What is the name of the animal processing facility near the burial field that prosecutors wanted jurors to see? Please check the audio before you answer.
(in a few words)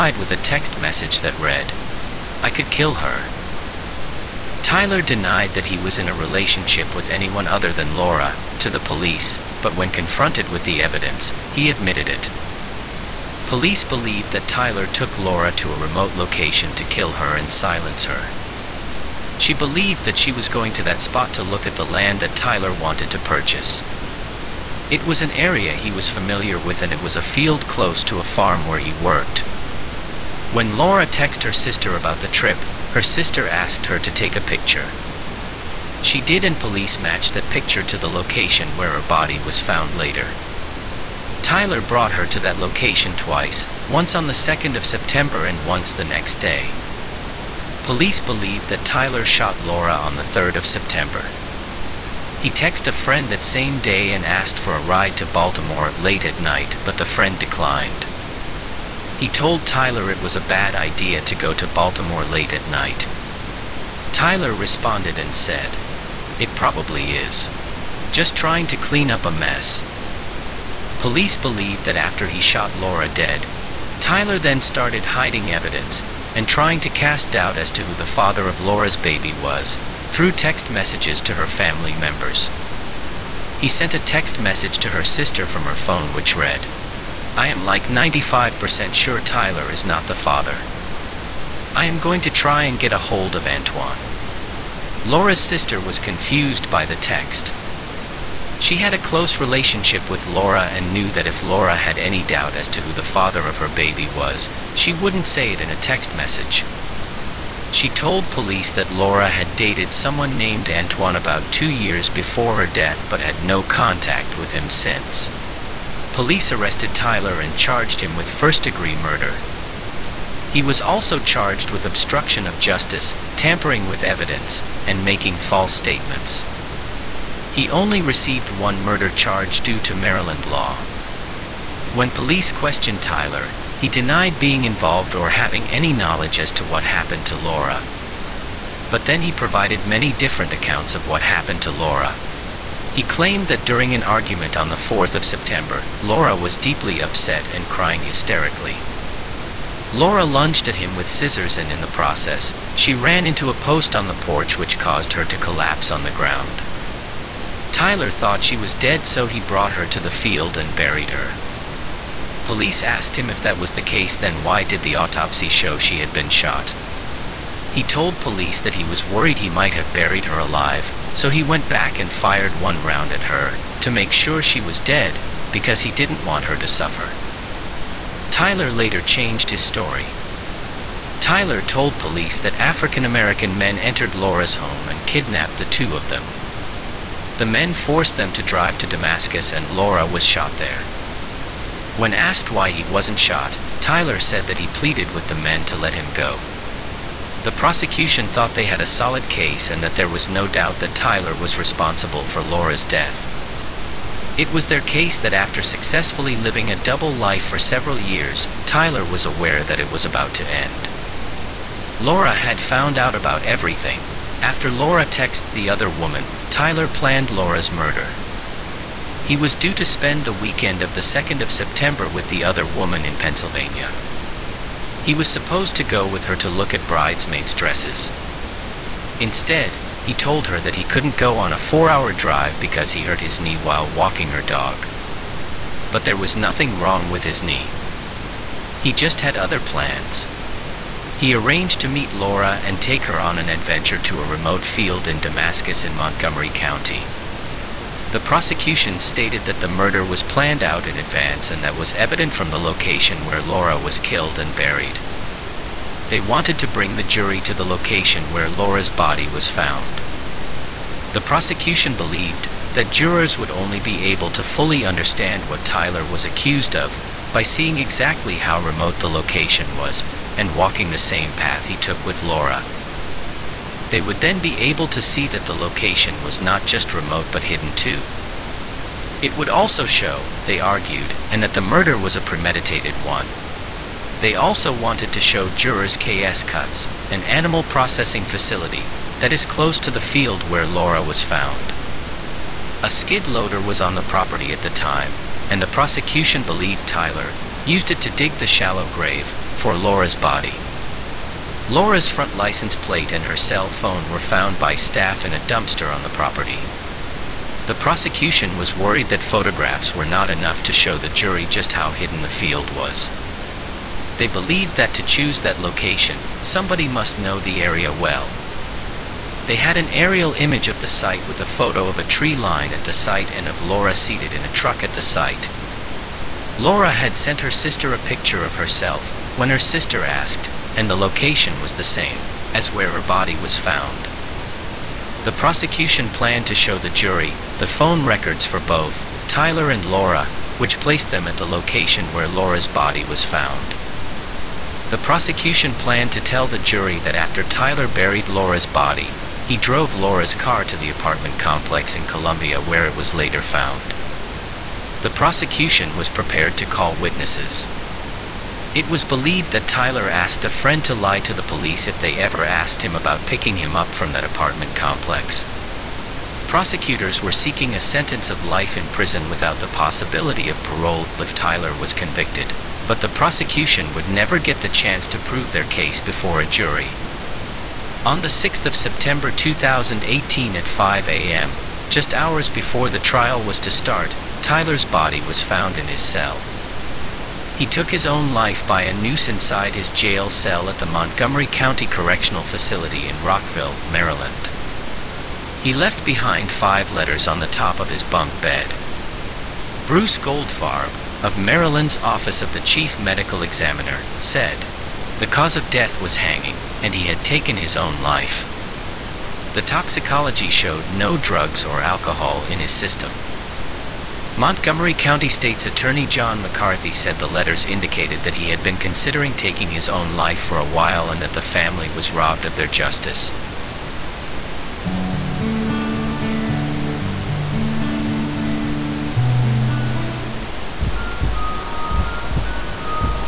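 KS Cuts.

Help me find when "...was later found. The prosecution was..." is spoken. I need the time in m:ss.
5:52.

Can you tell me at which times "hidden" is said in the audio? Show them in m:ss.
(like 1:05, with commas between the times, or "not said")
4:37, 5:11.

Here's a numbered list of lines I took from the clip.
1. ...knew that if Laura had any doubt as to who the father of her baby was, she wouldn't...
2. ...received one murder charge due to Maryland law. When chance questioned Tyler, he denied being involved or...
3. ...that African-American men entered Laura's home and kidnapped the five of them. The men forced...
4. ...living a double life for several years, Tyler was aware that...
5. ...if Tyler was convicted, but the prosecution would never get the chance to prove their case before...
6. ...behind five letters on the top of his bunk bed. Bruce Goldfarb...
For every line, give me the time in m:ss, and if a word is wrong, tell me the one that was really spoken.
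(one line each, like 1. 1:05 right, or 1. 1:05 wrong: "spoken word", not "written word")
1. 1:40 right
2. 2:08 wrong: "police", not "chance"
3. 3:02 wrong: "two", not "five"
4. 3:26 right
5. 6:11 right
6. 6:36 right.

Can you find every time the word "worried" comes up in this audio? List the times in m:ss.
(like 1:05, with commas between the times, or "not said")
2:49, 5:08.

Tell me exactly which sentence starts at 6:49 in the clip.
The toxicology showed no drugs or alcohol in his system.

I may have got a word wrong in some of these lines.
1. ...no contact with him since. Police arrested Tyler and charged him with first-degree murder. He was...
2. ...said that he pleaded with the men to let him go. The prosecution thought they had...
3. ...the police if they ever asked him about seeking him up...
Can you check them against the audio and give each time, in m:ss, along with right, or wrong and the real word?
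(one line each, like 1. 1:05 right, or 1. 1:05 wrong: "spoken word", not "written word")
1. 1:53 right
2. 3:14 right
3. 6:01 wrong: "picking", not "seeking".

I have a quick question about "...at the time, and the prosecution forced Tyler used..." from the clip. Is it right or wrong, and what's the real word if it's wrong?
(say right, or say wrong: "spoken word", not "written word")
wrong: "believed", not "forced".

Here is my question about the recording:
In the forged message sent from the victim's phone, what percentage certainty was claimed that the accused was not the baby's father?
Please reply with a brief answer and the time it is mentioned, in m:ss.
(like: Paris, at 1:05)
95%, at 1:27.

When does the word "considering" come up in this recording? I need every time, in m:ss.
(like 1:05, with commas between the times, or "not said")
6:58.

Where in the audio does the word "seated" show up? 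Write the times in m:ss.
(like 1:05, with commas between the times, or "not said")
5:23.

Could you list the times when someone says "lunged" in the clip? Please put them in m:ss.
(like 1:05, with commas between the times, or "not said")
2:30.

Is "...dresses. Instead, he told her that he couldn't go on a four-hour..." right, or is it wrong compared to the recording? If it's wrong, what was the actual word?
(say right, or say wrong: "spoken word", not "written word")
right.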